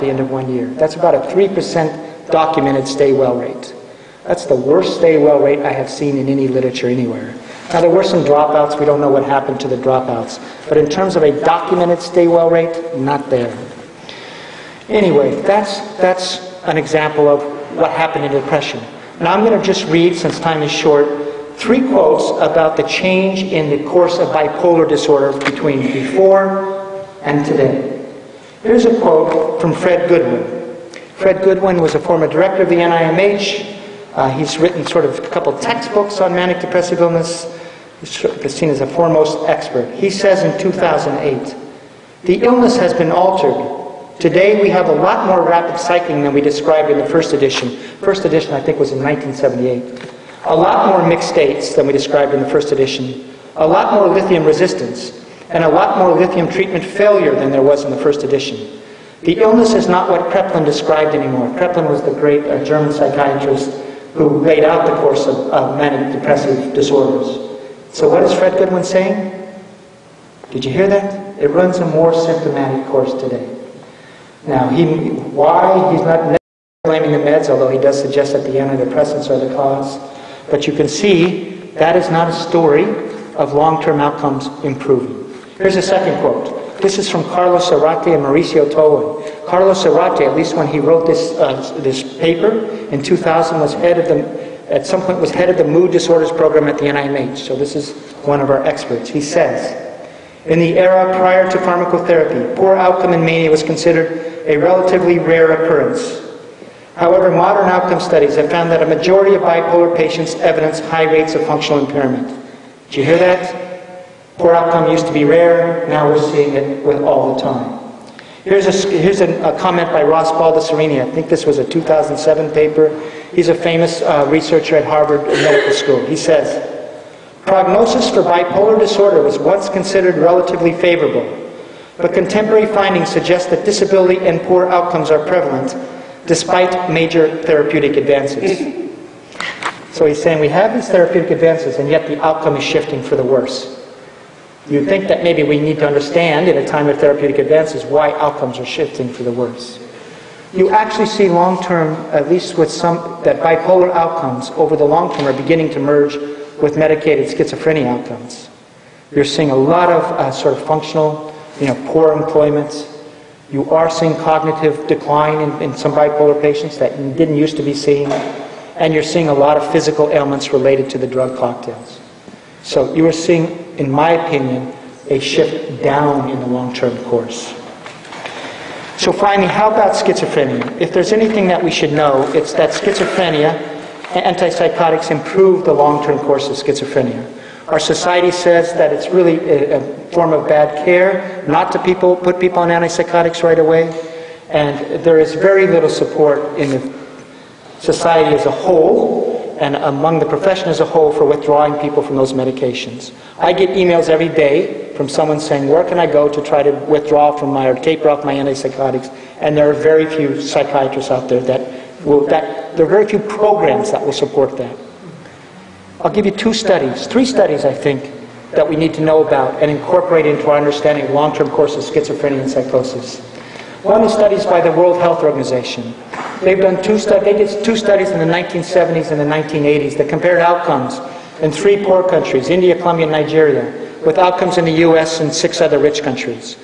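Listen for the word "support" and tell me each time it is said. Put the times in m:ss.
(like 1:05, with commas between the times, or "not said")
3:15, 3:34.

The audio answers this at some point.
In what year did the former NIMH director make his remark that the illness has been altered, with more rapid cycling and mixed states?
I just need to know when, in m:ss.
0:40.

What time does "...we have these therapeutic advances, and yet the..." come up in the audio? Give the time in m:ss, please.
2:20.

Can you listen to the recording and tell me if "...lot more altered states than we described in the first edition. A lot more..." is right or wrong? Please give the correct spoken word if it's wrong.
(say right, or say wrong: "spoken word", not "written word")
wrong: "mixed", not "altered".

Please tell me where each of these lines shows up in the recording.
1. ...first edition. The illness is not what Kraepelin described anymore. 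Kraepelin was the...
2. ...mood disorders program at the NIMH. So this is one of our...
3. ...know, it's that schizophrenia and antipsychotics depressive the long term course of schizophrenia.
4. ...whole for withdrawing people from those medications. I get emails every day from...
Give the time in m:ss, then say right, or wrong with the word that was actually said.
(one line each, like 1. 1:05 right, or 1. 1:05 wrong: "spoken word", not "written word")
1. 0:57 right
2. 1:35 right
3. 3:01 wrong: "improve", not "depressive"
4. 3:20 right.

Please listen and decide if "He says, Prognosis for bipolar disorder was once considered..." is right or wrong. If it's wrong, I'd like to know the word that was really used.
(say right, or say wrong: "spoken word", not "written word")
right.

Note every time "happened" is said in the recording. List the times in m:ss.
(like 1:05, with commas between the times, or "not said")
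0:09, 0:17.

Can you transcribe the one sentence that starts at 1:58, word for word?
Here's, a, here's a, a comment by Ross Baldessarini.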